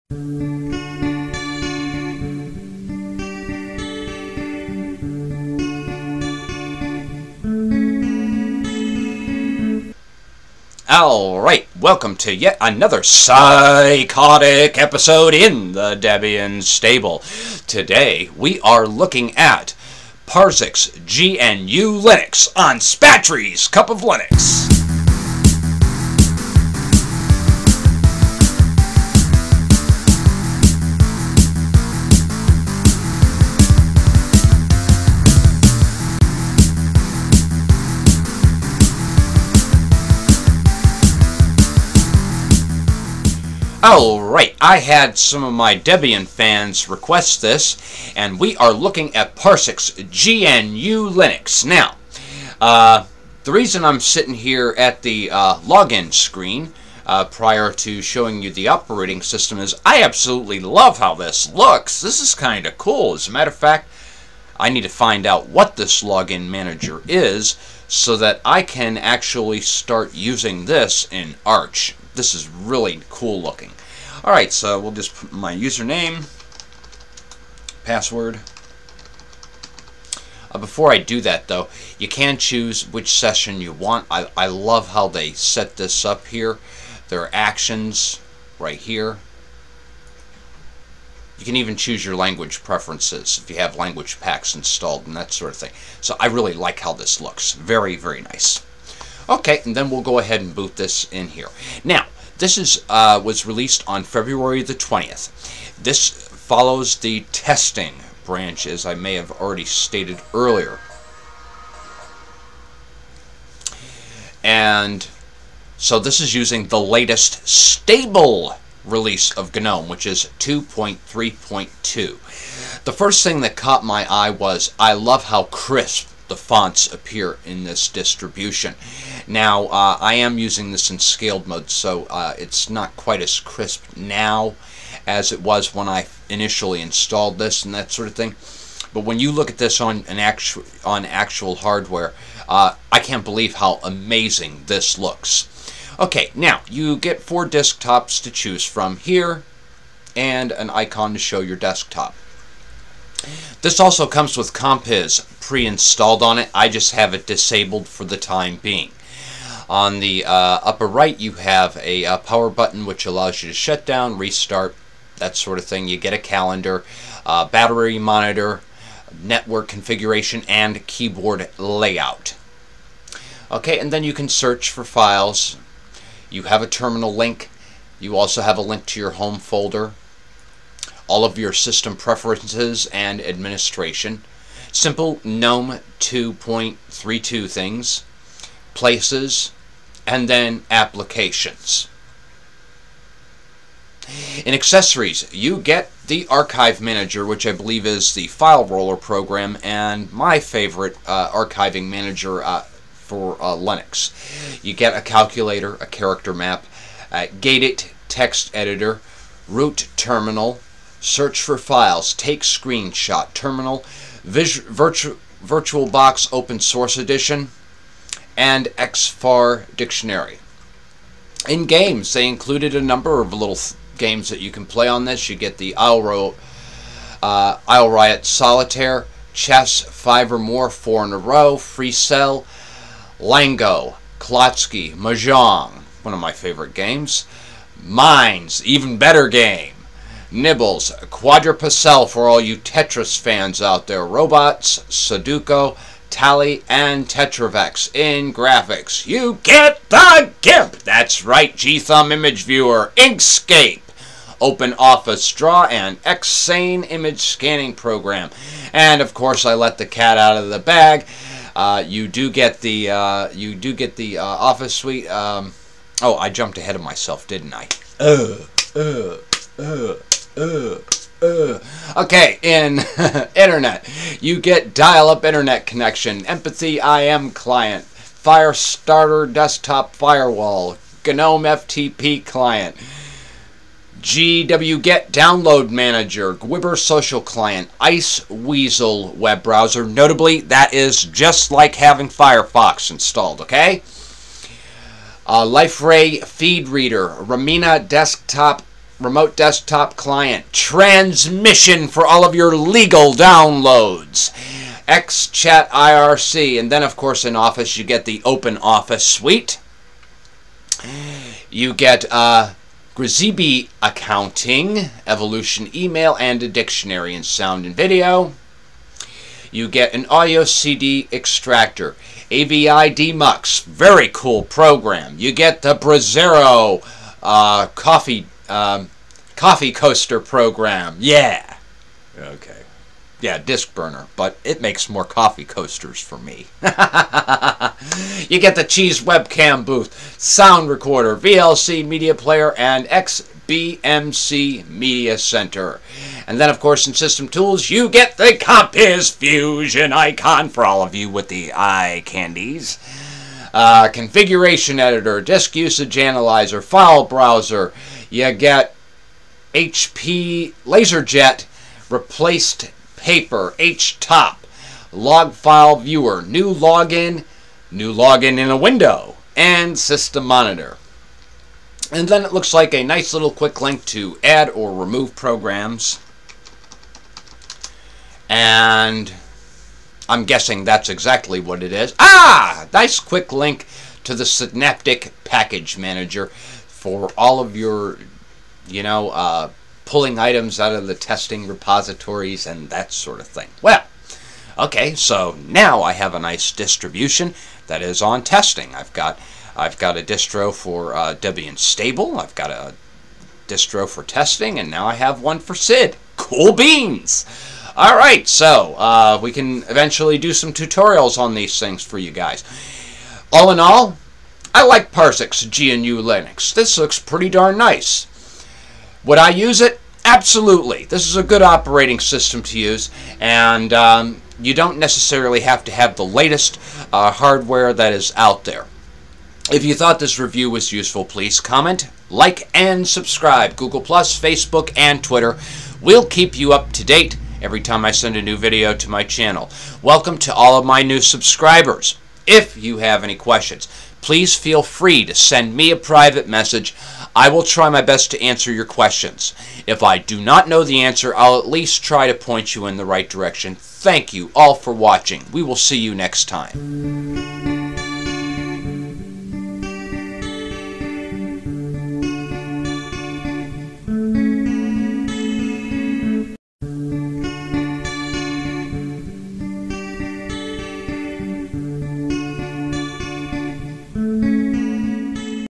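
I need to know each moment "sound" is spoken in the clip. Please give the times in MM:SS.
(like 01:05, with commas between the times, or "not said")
05:17, 05:40.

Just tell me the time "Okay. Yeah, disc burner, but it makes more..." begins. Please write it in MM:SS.
05:32.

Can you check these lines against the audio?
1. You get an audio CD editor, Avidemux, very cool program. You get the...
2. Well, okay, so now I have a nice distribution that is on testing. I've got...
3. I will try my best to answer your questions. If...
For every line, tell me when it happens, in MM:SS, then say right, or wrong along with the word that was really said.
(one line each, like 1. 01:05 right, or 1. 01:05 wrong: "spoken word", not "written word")
1. 05:19 wrong: "extractor", not "editor"
2. 06:33 right
3. 07:27 right.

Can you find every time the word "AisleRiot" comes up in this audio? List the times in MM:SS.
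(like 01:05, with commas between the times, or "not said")
03:47.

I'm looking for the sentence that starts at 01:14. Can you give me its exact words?
Alright, so we'll just put my username, password.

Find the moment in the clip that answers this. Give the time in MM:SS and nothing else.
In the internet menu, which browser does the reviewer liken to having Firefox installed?
04:47.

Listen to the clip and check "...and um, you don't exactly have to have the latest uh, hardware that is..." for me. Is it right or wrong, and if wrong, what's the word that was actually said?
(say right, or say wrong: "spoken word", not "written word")
wrong: "necessarily", not "exactly".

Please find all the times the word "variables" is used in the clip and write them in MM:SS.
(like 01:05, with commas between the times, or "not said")
not said.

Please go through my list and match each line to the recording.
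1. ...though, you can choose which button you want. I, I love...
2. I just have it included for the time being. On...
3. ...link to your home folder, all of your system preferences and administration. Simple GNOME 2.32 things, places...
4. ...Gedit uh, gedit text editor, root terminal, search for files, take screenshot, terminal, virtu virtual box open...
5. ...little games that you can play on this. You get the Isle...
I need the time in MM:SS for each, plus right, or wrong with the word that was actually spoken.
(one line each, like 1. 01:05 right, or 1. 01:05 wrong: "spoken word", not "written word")
1. 01:21 wrong: "session", not "button"
2. 02:36 wrong: "disabled", not "included"
3. 02:58 right
4. 03:27 right
5. 03:43 right.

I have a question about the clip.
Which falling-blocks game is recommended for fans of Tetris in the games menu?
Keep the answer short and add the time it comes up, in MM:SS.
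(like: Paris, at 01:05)
Quadrapassel, at 04:01.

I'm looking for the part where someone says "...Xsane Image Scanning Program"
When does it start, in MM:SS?
04:16.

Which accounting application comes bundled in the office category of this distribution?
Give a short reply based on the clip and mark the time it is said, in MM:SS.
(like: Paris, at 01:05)
Grisbi, at 05:12.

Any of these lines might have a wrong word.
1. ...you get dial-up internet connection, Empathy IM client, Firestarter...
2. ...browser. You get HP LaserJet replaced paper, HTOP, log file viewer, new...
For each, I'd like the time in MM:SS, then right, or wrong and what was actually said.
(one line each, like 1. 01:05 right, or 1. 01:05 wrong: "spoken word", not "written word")
1. 04:34 right
2. 05:57 right.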